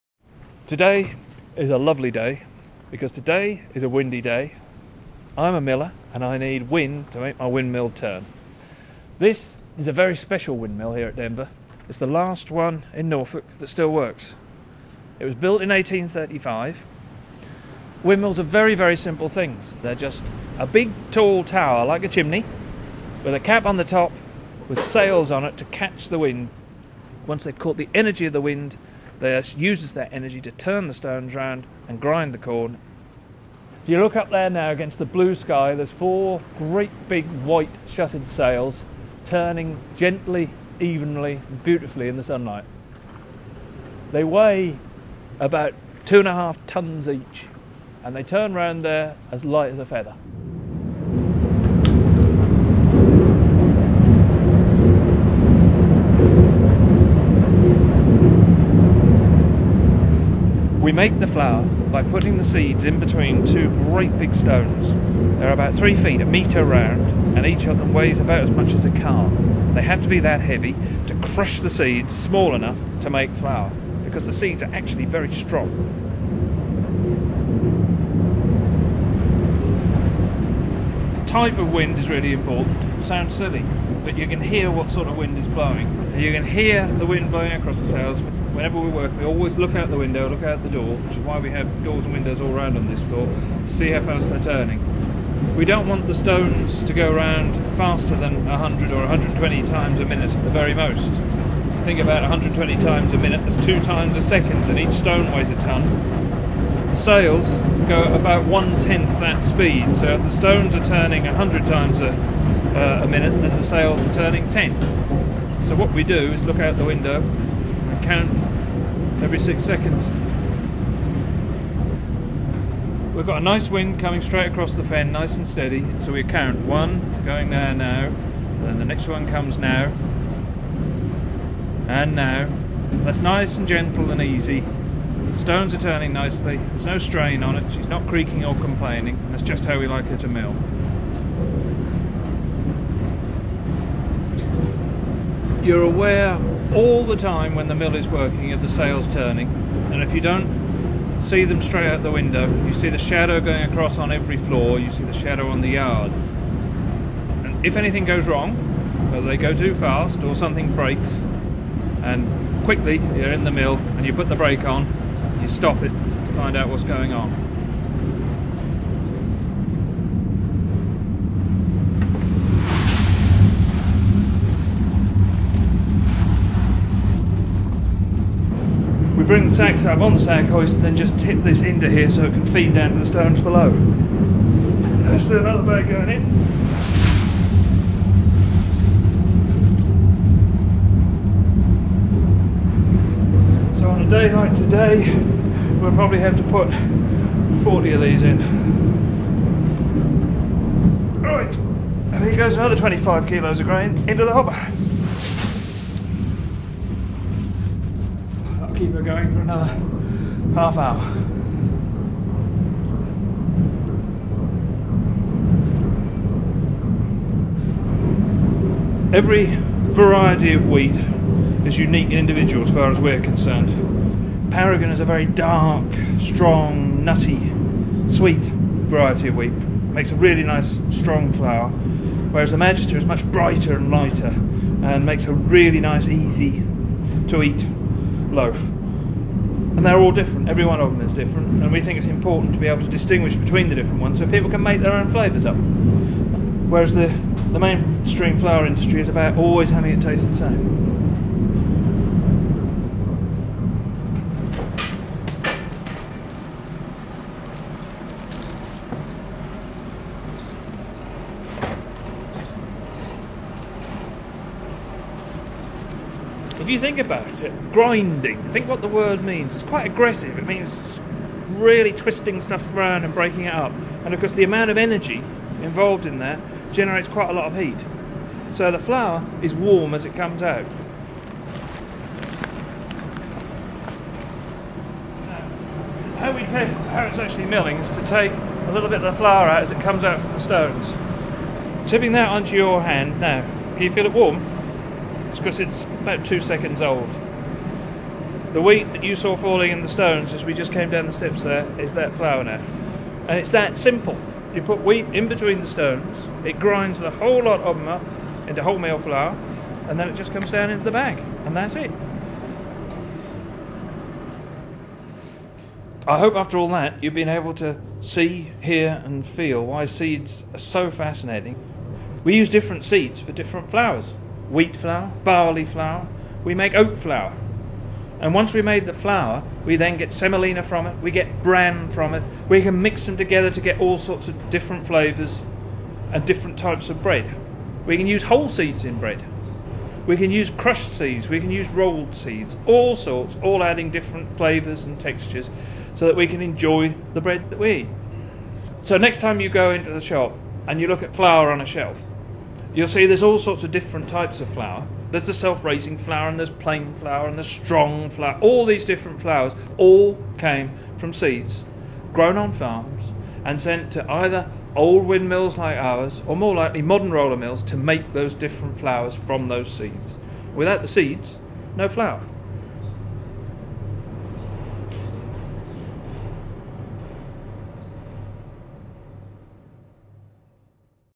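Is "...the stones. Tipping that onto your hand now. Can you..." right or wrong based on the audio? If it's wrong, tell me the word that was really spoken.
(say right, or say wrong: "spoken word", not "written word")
right.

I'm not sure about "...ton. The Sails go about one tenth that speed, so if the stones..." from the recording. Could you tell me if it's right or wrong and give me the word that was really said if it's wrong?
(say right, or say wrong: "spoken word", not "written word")
right.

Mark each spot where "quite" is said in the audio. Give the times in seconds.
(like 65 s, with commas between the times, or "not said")
269 s, 277 s.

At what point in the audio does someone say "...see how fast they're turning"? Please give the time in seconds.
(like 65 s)
93 s.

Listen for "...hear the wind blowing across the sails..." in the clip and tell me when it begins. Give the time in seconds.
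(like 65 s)
86 s.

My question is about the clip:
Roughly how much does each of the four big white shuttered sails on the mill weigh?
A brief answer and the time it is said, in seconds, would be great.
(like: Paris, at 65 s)
2.5 tons, at 46 s.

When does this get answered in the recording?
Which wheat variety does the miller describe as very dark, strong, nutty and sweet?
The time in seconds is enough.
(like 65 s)
224 s.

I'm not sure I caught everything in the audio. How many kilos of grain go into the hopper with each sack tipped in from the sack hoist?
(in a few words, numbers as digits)
25 kilos.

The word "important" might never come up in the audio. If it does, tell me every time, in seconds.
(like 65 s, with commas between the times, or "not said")
82 s, 242 s.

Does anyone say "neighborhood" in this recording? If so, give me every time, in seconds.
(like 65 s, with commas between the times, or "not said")
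not said.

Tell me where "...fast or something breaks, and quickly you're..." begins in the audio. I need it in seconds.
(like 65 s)
159 s.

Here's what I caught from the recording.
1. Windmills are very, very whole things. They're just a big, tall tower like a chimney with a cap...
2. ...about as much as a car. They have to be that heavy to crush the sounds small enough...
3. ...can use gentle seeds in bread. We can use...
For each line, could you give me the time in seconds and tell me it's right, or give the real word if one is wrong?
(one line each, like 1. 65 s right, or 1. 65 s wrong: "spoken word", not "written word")
1. 18 s wrong: "simple", not "whole"
2. 68 s wrong: "seeds", not "sounds"
3. 337 s wrong: "whole", not "gentle".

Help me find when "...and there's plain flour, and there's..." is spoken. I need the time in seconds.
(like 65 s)
356 s.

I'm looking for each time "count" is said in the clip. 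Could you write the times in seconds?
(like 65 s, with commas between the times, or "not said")
118 s, 126 s.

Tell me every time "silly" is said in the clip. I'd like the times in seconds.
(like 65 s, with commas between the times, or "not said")
83 s.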